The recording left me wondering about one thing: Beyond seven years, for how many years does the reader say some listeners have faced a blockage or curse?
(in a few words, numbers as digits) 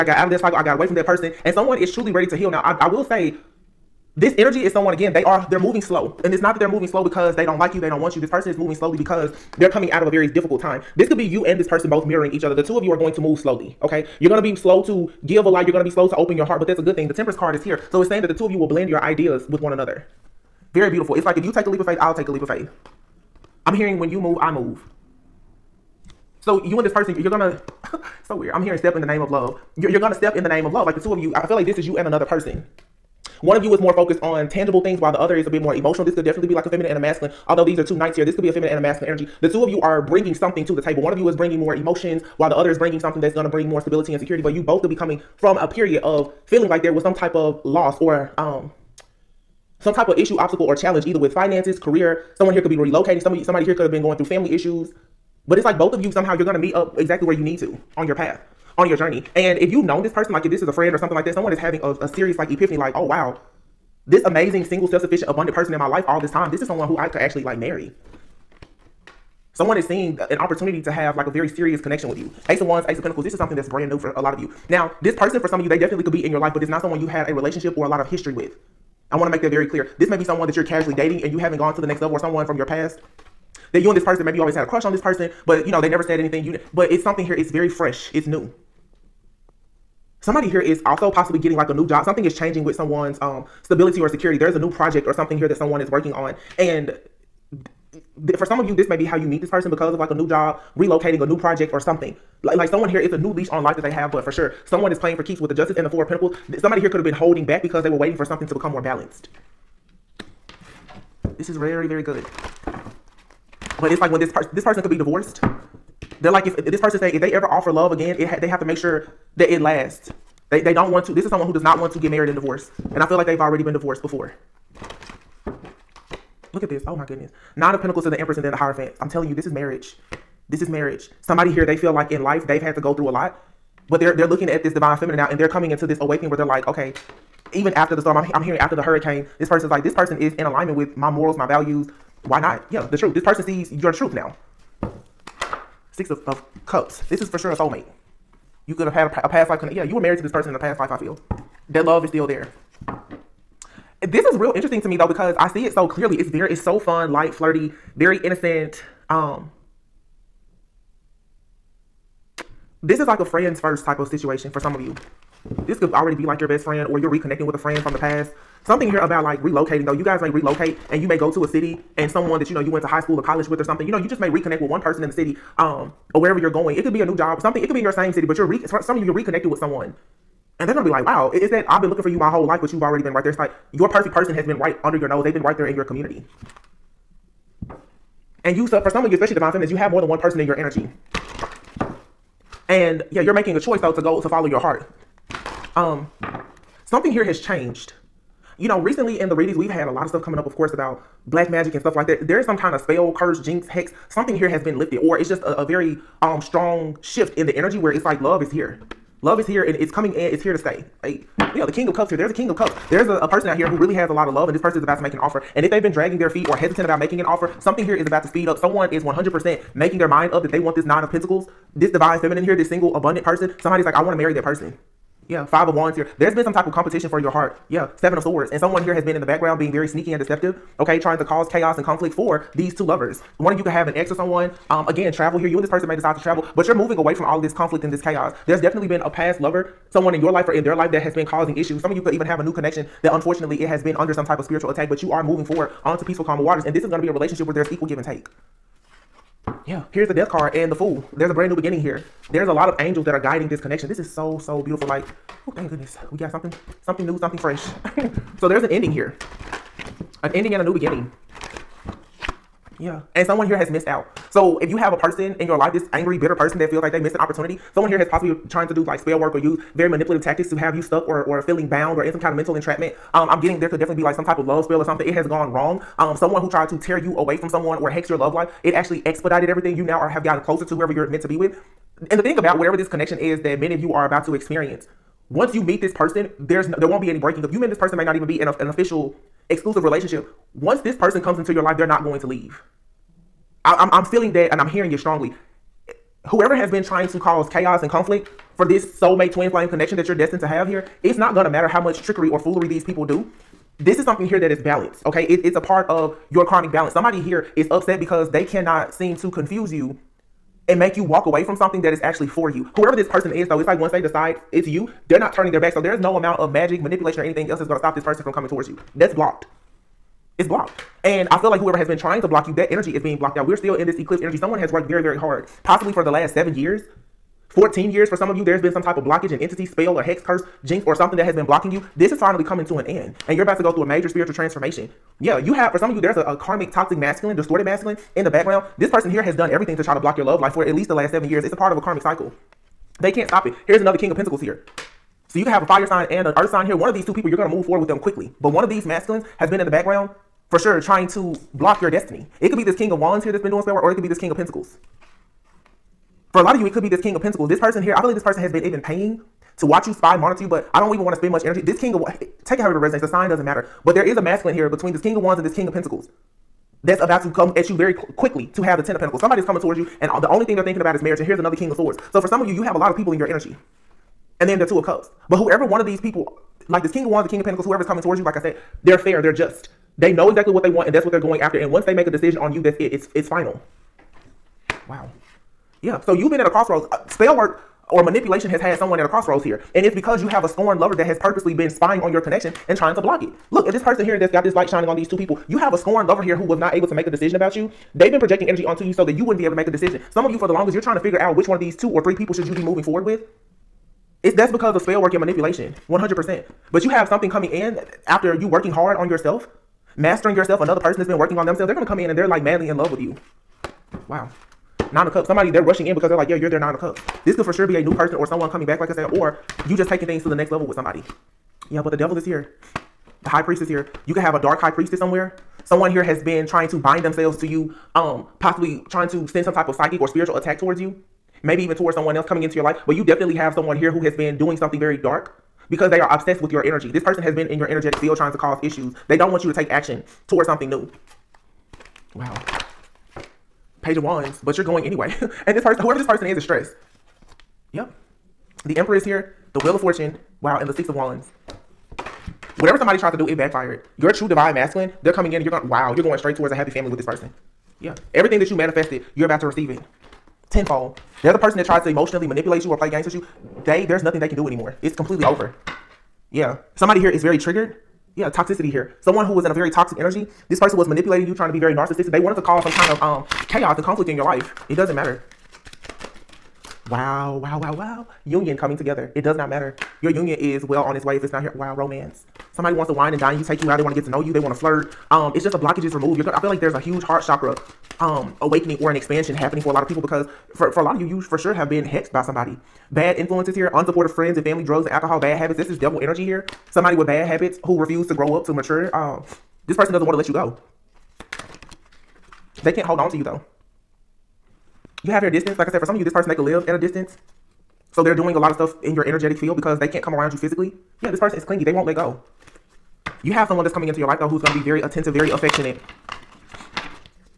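14.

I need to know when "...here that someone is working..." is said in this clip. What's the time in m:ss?
1:35.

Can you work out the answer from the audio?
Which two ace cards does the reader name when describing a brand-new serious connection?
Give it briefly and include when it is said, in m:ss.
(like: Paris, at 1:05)
Ace of Wands, Ace of Pentacles, at 1:12.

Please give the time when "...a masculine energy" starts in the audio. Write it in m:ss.
0:38.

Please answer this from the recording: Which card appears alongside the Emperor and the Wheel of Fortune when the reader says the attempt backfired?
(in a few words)
Six of Wands.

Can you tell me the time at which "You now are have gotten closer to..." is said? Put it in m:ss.
4:39.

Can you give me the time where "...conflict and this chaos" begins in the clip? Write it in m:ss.
3:57.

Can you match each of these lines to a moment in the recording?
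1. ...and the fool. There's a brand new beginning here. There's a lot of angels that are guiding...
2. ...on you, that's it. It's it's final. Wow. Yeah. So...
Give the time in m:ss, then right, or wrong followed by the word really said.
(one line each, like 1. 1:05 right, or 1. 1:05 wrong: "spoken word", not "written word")
1. 4:10 right
2. 6:22 right.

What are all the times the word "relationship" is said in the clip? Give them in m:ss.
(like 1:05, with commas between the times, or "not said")
1:17, 4:07, 4:49.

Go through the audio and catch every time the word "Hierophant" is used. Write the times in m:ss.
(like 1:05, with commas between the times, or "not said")
2:08.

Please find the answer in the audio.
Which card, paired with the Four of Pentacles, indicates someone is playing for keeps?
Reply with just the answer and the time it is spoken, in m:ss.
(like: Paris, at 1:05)
Justice, at 1:45.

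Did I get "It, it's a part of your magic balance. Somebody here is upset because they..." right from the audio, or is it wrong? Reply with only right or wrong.
wrong.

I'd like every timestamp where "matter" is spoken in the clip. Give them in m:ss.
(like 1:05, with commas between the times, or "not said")
5:01, 6:03, 7:54, 7:59.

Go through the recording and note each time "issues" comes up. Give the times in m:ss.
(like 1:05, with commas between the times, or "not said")
0:50, 0:54, 4:01, 7:18.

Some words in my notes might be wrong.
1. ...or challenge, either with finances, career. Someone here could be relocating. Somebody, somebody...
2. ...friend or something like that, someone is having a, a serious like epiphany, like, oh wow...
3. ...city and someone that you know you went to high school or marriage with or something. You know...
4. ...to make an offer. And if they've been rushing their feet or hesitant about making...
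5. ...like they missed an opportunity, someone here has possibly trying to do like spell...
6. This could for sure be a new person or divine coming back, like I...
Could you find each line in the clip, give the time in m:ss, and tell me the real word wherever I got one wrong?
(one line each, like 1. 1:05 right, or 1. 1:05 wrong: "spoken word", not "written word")
1. 0:50 right
2. 1:00 right
3. 2:51 wrong: "college", not "marriage"
4. 3:34 wrong: "dragging", not "rushing"
5. 4:26 right
6. 6:57 wrong: "someone", not "divine".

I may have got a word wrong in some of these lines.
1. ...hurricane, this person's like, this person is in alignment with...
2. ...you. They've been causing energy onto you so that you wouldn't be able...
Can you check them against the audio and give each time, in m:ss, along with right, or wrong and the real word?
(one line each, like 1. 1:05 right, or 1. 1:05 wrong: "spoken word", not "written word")
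1. 2:18 right
2. 6:37 wrong: "projecting", not "causing".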